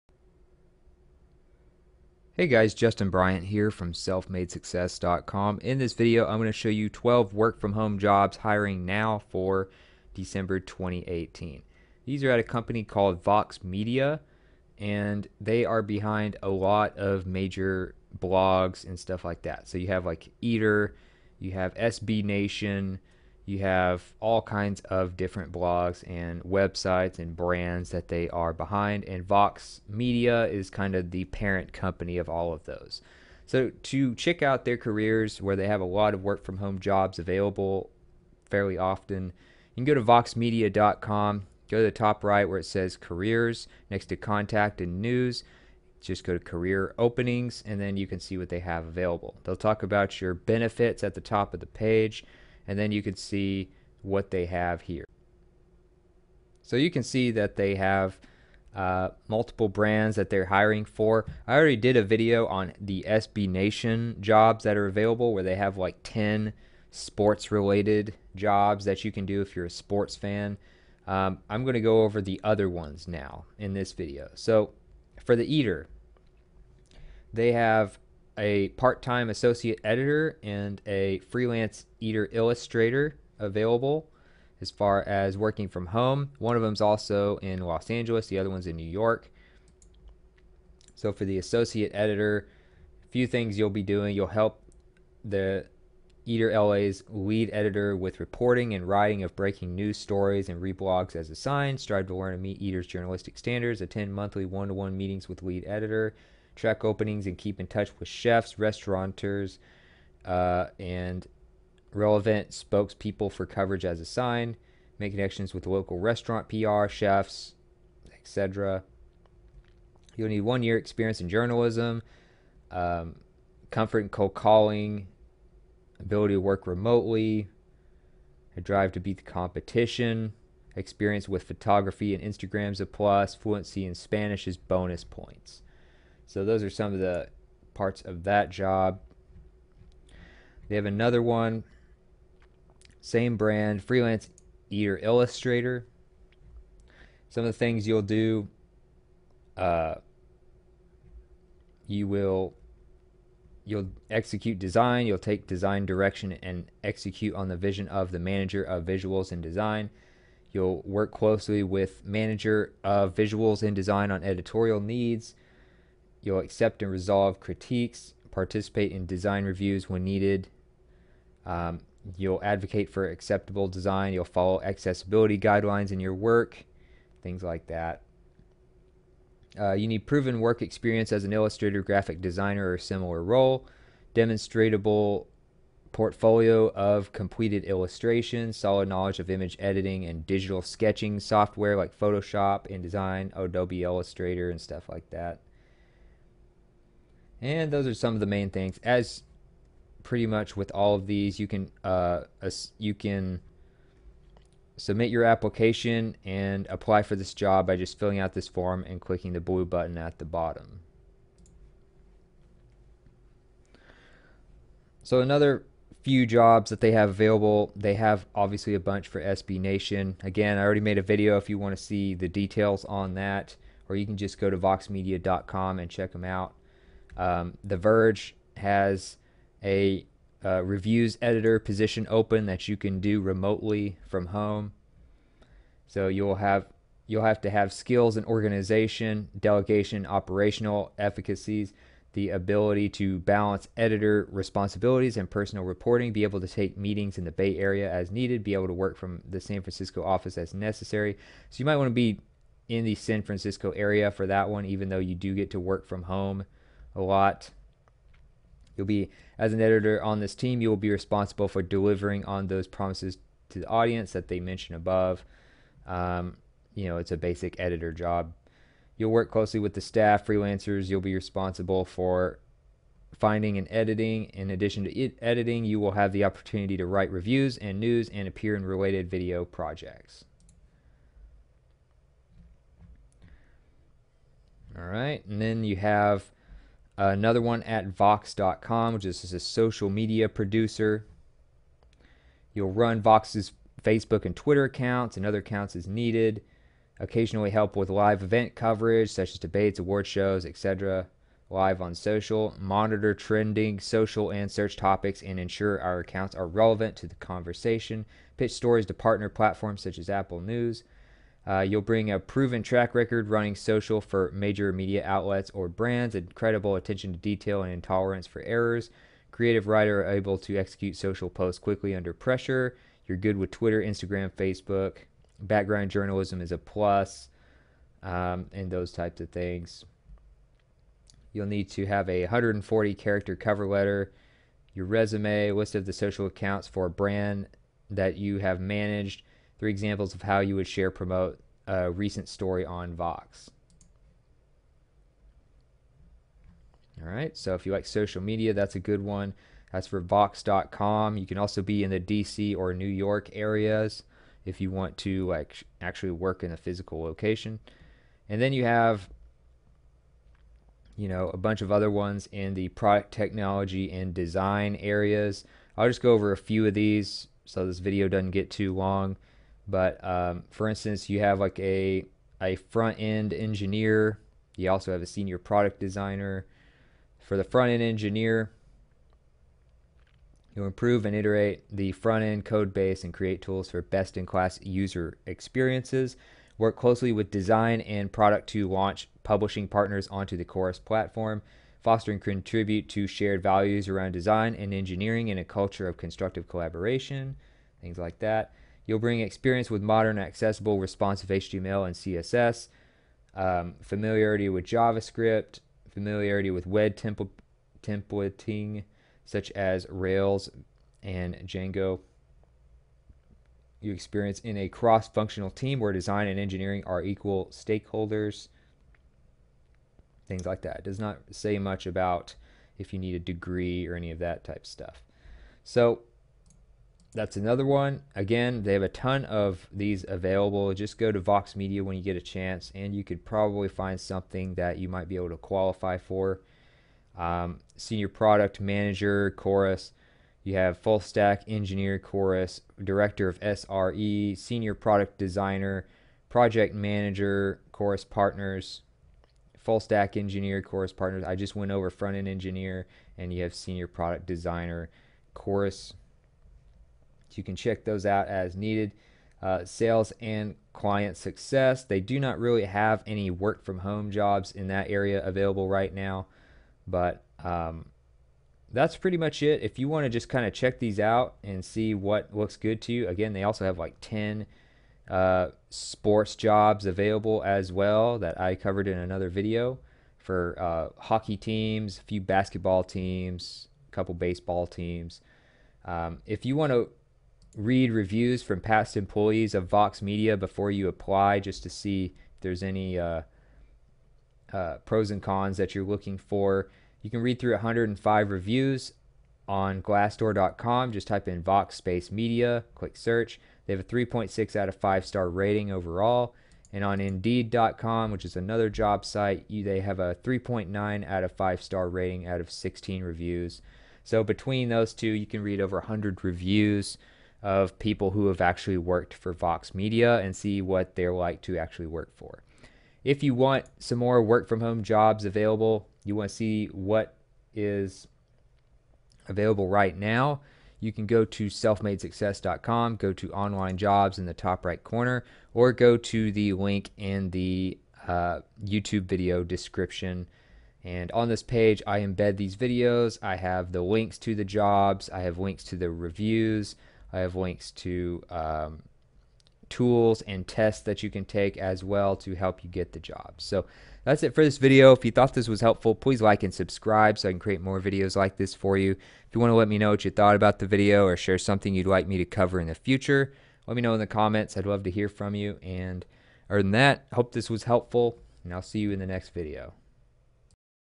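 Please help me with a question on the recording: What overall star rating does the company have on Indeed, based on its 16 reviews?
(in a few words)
3.9 out of 5.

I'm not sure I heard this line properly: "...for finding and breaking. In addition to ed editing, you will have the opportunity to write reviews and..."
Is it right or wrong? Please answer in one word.
wrong.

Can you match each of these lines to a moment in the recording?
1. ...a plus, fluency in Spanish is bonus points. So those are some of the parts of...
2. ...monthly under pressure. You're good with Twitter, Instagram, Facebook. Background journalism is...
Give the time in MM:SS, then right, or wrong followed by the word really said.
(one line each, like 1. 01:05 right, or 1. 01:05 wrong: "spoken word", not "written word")
1. 02:12 right
2. 05:21 wrong: "quickly", not "monthly".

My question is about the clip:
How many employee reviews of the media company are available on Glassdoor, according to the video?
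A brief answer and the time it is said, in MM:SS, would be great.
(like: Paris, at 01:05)
105, at 08:17.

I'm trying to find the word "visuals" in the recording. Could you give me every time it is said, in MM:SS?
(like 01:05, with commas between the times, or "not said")
02:38, 02:43.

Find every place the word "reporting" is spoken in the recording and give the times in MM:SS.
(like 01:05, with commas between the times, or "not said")
01:38, 04:05.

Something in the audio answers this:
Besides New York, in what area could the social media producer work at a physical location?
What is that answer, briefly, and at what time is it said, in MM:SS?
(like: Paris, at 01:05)
DC, at 05:51.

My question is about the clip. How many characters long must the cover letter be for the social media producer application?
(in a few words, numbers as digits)
140.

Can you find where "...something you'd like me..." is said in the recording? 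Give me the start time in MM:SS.
09:21.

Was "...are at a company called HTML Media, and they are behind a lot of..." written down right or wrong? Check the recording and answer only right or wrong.
wrong.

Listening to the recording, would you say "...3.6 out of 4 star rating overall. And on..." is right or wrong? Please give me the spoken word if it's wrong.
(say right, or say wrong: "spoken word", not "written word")
wrong: "5", not "4".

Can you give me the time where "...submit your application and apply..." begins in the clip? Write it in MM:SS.
03:24.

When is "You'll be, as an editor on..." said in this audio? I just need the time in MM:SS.
04:18.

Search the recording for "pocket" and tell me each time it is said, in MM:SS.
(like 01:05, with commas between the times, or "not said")
not said.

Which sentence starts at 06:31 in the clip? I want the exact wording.
Foster and contribute to shared values around design and engineering in a culture of constructive collaboration, things like that.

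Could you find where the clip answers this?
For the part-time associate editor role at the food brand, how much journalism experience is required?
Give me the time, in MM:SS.
02:00.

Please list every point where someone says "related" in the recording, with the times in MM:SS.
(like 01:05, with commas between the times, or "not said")
01:07, 04:38.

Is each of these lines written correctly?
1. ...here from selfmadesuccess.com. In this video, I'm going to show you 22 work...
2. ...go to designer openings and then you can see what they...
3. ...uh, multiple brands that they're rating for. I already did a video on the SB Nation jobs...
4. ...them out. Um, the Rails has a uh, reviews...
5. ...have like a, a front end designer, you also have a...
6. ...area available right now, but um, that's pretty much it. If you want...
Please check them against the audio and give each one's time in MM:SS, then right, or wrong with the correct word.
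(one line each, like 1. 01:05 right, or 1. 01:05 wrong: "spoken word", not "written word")
1. 00:03 wrong: "12", not "22"
2. 00:46 wrong: "career", not "designer"
3. 00:58 wrong: "hiring", not "rating"
4. 03:46 wrong: "Verge", not "Rails"
5. 06:11 wrong: "engineer", not "designer"
6. 07:44 right.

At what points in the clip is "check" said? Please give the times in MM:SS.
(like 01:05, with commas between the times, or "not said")
00:34, 03:45, 07:37, 07:50.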